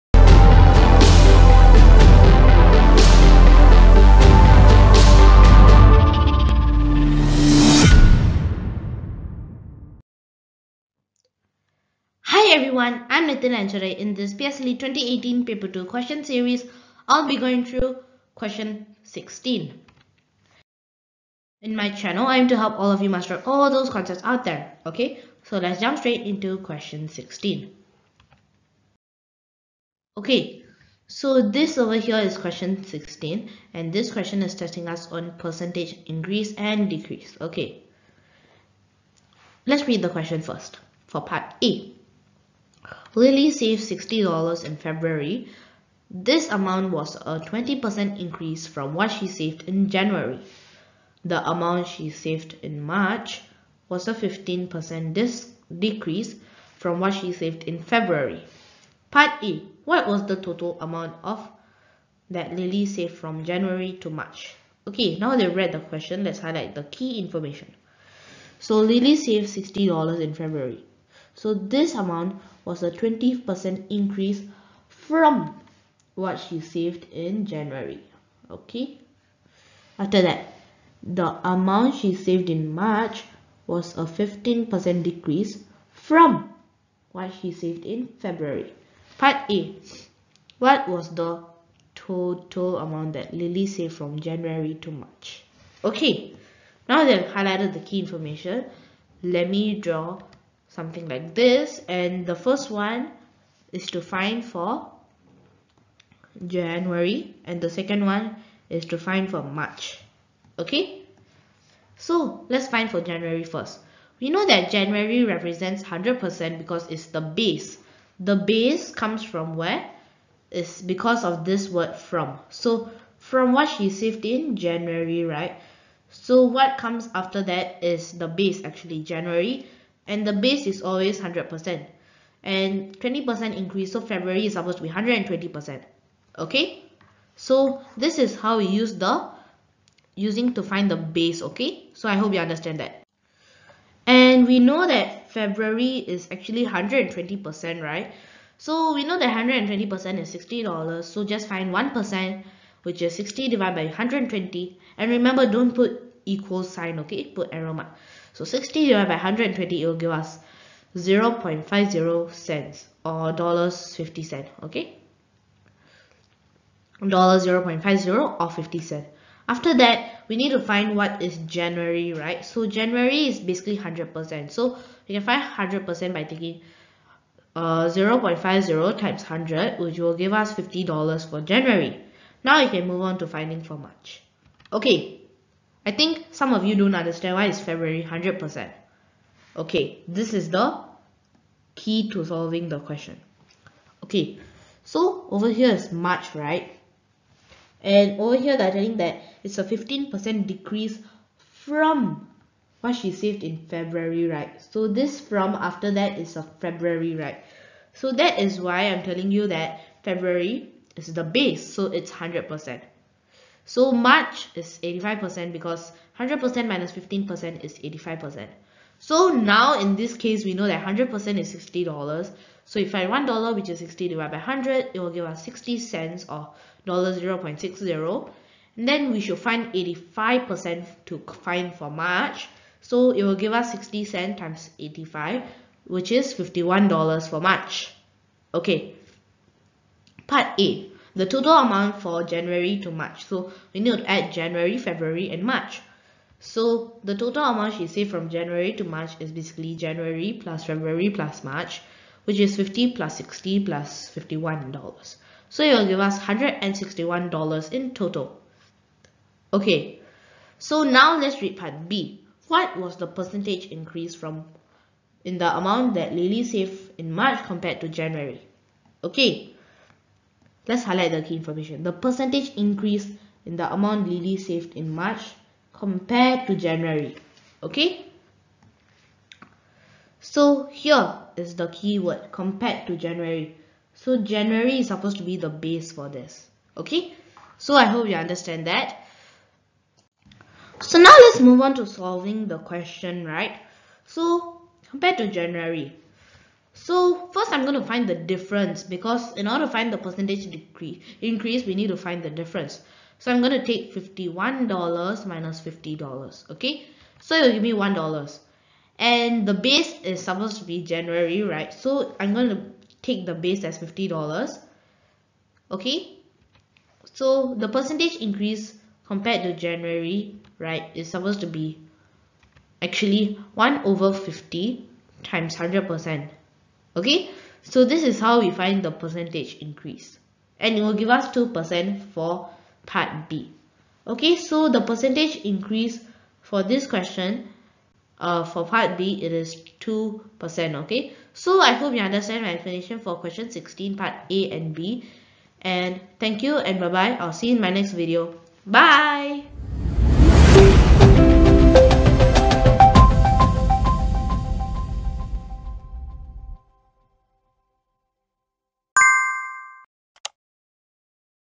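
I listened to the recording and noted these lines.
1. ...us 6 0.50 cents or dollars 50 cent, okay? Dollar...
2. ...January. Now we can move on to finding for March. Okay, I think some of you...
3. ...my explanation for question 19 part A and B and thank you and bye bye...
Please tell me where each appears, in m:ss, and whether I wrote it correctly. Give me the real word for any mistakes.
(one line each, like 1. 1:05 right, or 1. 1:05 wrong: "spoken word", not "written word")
1. 2:40 wrong: "0", not "6"
2. 3:01 right
3. 5:42 wrong: "16", not "19".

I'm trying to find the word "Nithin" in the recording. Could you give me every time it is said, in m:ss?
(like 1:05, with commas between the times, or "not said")
0:13.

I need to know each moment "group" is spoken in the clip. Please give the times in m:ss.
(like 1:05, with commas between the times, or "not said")
not said.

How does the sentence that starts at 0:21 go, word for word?
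In my channel, I'm to help all of you master all those concepts out there.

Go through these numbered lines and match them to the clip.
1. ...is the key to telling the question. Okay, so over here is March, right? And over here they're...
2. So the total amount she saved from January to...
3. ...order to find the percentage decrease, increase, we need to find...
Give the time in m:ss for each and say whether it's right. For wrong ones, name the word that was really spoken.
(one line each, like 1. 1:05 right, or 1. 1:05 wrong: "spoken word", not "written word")
1. 3:10 wrong: "solving", not "telling"
2. 4:06 right
3. 4:59 right.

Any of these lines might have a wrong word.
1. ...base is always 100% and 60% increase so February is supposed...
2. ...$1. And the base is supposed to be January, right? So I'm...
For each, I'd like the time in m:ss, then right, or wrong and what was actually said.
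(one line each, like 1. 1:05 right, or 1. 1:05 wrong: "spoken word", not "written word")
1. 2:10 wrong: "20", not "60"
2. 5:07 right.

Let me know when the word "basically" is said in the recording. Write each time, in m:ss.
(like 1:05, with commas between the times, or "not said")
2:53, 4:09.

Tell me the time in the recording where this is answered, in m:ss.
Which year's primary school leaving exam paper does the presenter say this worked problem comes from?
0:14.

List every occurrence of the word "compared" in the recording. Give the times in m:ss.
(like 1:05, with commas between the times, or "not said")
4:27, 4:35, 4:42, 4:54, 5:19.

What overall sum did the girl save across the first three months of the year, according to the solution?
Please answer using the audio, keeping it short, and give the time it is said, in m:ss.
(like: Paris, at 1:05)
$161, at 4:16.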